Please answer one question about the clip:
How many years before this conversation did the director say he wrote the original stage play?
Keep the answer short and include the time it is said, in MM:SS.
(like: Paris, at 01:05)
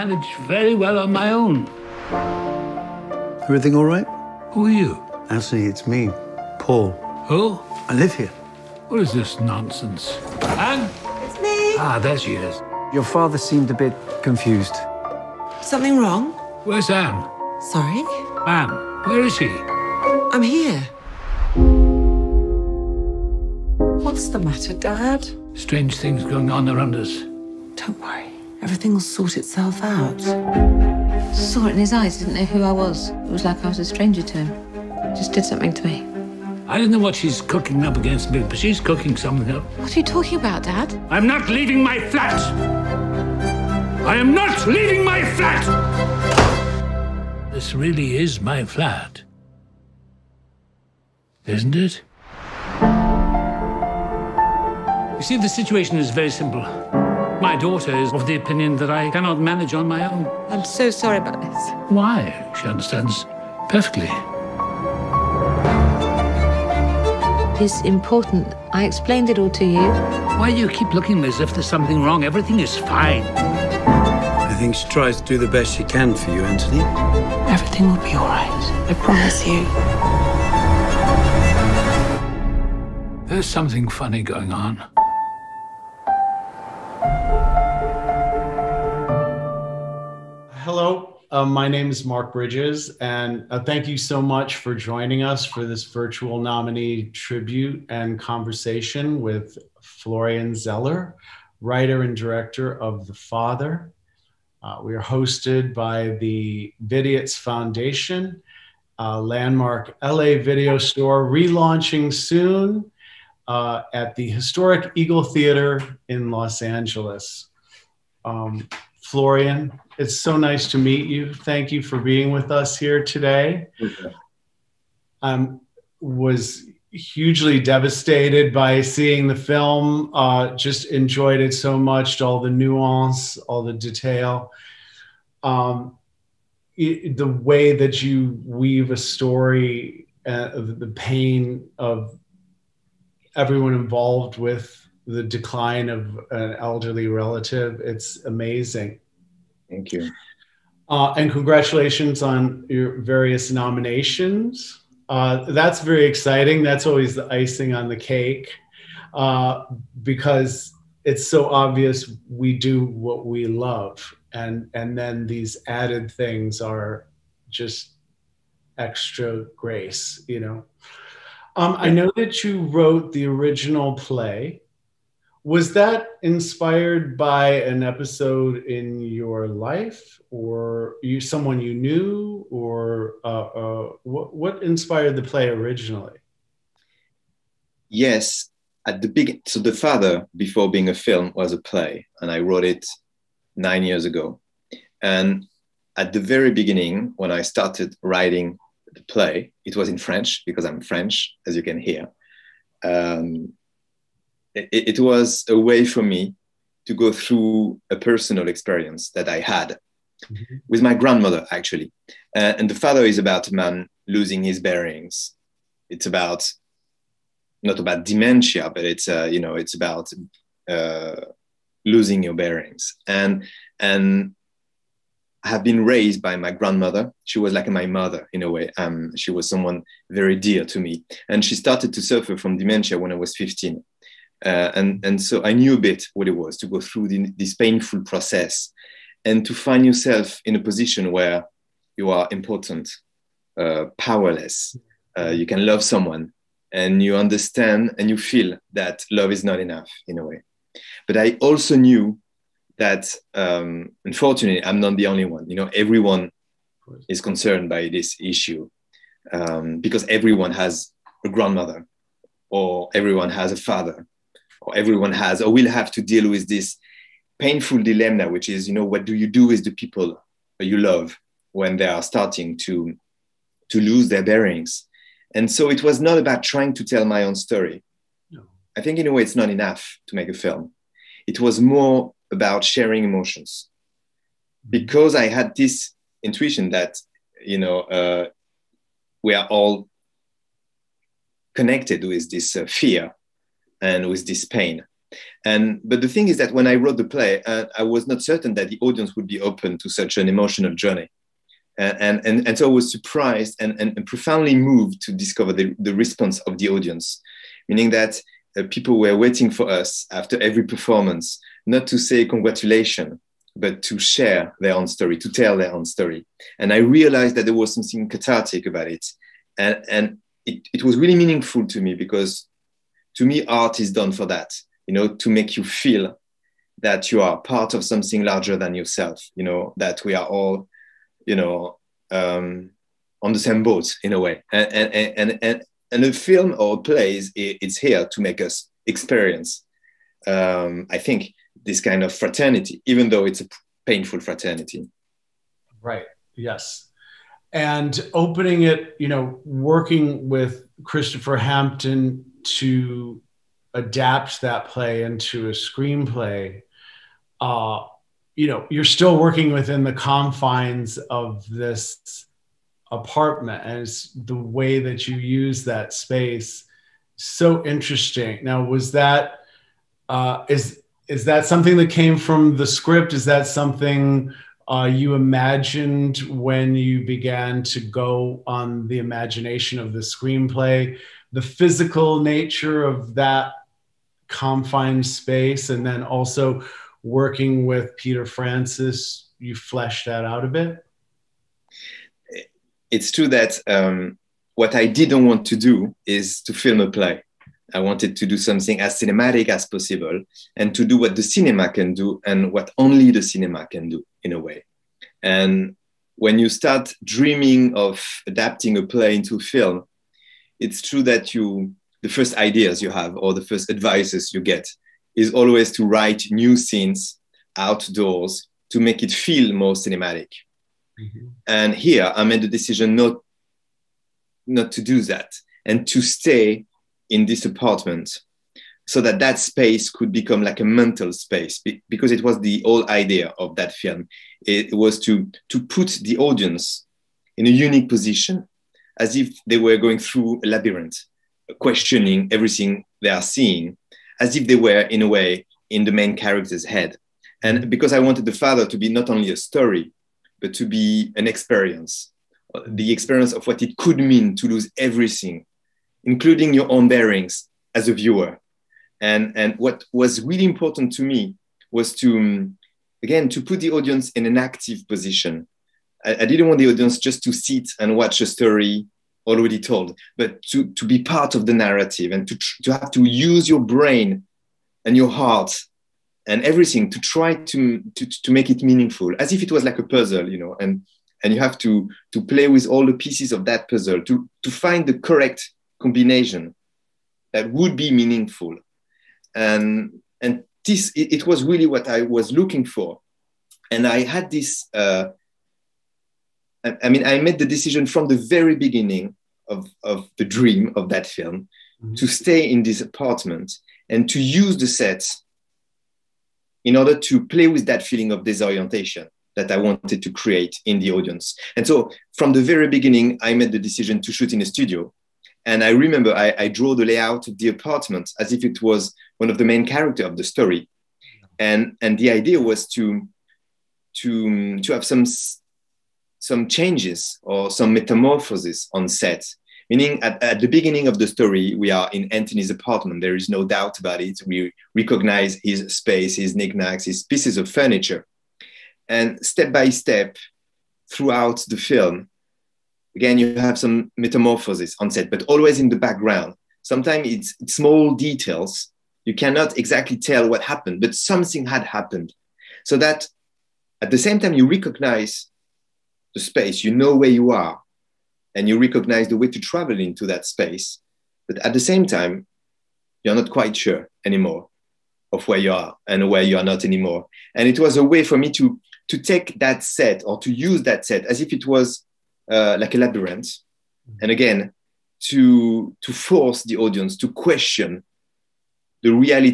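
9, at 03:13.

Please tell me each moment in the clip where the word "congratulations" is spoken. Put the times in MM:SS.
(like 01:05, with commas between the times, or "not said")
02:31, 05:12.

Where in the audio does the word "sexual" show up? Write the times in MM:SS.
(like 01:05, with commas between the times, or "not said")
not said.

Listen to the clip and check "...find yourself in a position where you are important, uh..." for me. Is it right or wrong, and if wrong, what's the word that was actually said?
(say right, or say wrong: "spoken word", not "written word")
right.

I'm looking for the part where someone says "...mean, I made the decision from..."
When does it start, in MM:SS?
08:16.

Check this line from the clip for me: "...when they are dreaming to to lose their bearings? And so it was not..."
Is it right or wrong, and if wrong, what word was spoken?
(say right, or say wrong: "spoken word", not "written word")
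wrong: "starting", not "dreaming".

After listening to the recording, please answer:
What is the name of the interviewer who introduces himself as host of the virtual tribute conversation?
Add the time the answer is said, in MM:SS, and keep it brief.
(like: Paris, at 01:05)
Mark Bridges, at 01:32.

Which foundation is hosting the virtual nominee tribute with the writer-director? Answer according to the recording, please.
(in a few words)
Vidiots Foundation.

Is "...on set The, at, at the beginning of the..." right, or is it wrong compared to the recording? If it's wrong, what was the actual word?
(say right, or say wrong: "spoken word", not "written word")
wrong: "Meaning", not "The".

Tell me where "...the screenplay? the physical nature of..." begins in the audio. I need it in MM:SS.
06:19.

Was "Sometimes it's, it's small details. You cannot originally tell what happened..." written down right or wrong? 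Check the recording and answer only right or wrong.
wrong.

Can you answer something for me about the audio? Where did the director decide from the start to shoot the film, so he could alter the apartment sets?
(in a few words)
A studio.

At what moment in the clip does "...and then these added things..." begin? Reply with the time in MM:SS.
02:44.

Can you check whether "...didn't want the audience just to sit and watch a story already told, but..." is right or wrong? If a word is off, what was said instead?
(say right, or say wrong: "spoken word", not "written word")
right.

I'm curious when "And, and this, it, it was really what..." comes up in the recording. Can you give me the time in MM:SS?
08:09.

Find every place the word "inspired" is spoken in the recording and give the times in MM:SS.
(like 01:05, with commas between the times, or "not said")
02:56, 03:04.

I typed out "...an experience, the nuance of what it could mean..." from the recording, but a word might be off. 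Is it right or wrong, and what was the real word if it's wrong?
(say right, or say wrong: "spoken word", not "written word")
wrong: "experience", not "nuance".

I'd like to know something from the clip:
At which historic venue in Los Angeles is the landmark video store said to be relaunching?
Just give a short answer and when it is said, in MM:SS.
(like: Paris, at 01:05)
Eagle Theater, at 01:54.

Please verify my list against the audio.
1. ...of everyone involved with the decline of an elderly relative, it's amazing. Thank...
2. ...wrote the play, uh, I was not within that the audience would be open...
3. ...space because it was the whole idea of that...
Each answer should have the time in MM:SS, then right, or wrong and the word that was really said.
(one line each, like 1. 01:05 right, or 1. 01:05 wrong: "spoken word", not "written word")
1. 02:21 right
2. 04:56 wrong: "certain", not "within"
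3. 07:11 right.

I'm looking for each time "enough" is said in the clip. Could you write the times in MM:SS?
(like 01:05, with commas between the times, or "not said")
04:09, 04:39.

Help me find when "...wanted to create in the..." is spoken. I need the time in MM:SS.
08:29.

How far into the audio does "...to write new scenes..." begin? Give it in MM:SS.
06:55.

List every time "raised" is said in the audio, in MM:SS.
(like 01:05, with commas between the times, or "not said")
03:45.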